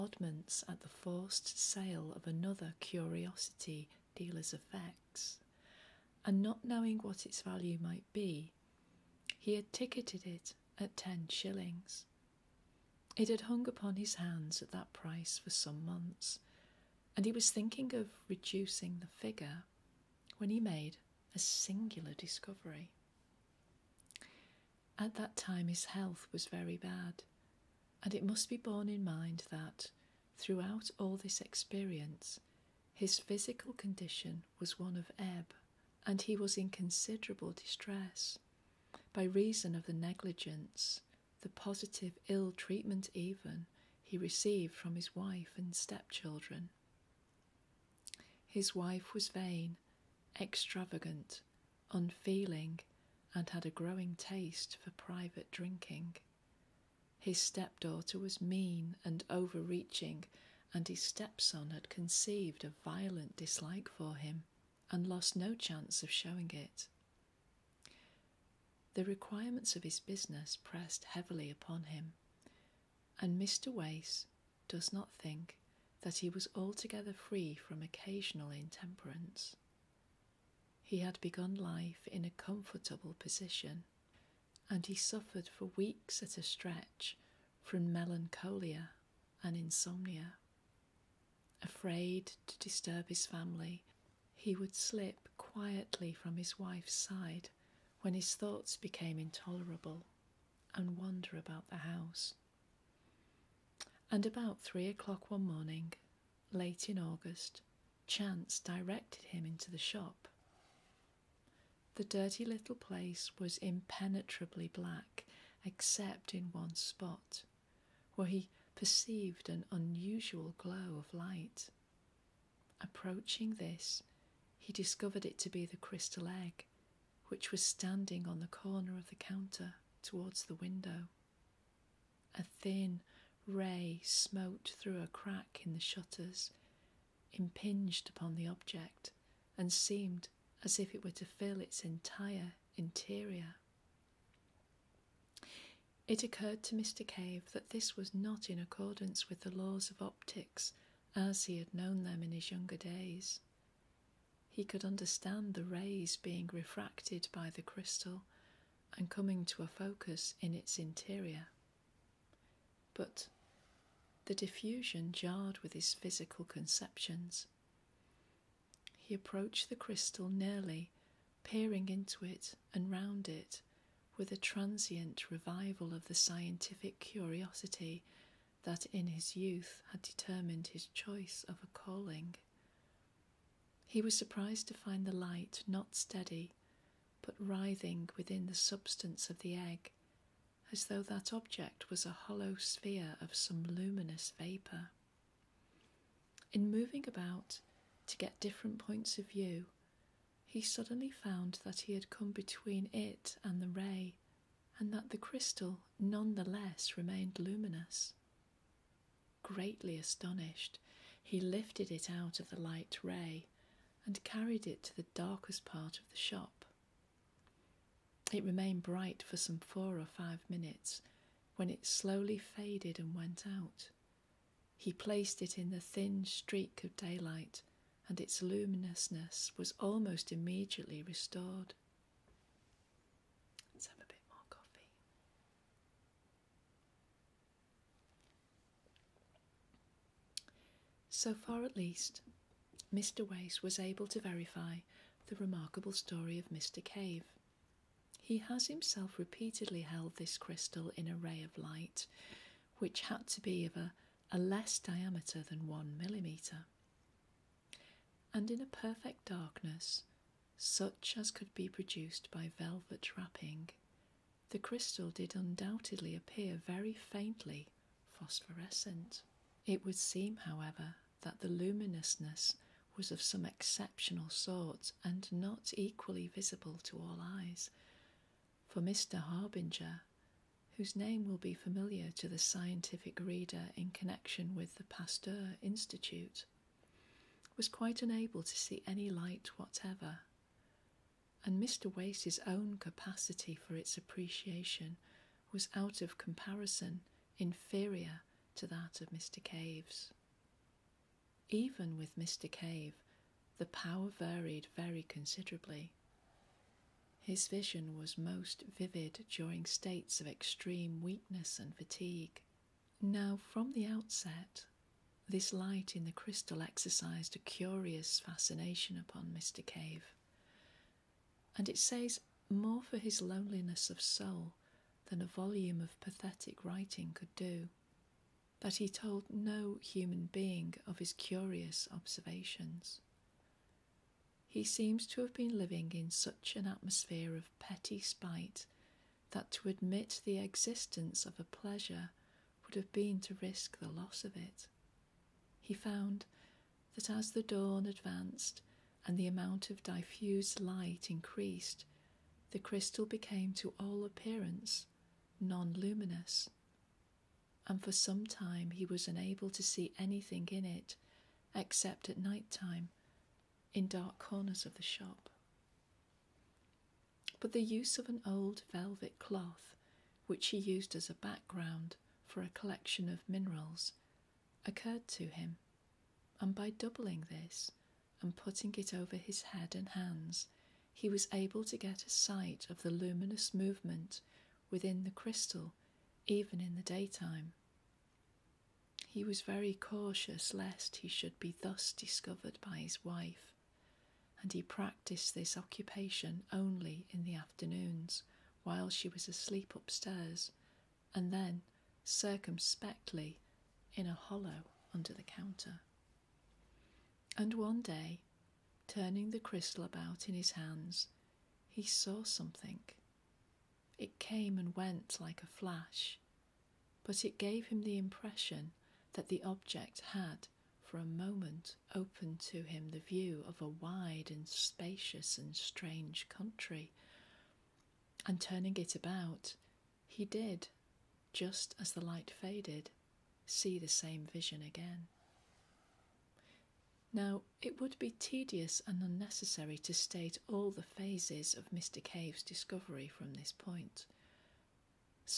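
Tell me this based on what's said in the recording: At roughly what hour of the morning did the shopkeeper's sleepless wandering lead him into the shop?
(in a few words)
3 o'clock.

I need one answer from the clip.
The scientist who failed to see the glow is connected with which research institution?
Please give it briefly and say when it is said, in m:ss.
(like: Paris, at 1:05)
Pasteur Institute, at 4:44.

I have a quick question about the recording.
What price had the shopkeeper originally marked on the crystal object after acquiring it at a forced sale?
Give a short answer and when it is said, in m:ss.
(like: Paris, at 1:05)
10 shillings, at 0:10.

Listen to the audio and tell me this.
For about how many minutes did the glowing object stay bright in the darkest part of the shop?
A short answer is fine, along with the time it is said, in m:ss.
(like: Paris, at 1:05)
4 or 5 minutes, at 3:39.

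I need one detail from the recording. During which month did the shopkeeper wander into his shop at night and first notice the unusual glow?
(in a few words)
August.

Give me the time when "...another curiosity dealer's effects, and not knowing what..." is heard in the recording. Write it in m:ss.
0:02.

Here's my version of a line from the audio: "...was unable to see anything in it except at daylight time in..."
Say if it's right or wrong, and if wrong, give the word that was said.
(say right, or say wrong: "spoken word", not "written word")
wrong: "night", not "daylight".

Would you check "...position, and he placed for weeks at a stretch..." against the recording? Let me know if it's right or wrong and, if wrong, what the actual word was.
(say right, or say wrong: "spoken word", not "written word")
wrong: "suffered", not "placed".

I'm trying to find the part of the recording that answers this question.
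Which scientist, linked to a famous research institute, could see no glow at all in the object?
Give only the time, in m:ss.
4:38.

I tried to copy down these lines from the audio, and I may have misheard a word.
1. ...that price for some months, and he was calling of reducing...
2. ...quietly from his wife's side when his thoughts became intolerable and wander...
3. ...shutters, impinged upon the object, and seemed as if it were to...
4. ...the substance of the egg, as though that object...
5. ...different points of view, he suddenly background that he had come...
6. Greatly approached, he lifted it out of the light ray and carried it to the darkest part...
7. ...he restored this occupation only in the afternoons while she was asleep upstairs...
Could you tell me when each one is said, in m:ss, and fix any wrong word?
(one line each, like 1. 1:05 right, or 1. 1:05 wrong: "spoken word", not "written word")
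1. 0:14 wrong: "thinking", not "calling"
2. 1:35 right
3. 2:15 right
4. 3:08 right
5. 3:18 wrong: "found", not "background"
6. 3:29 wrong: "astonished", not "approached"
7. 6:34 wrong: "practiced", not "restored".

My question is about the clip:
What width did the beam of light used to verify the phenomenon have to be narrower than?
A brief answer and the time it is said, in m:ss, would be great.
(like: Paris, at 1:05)
1 millimetre, at 4:15.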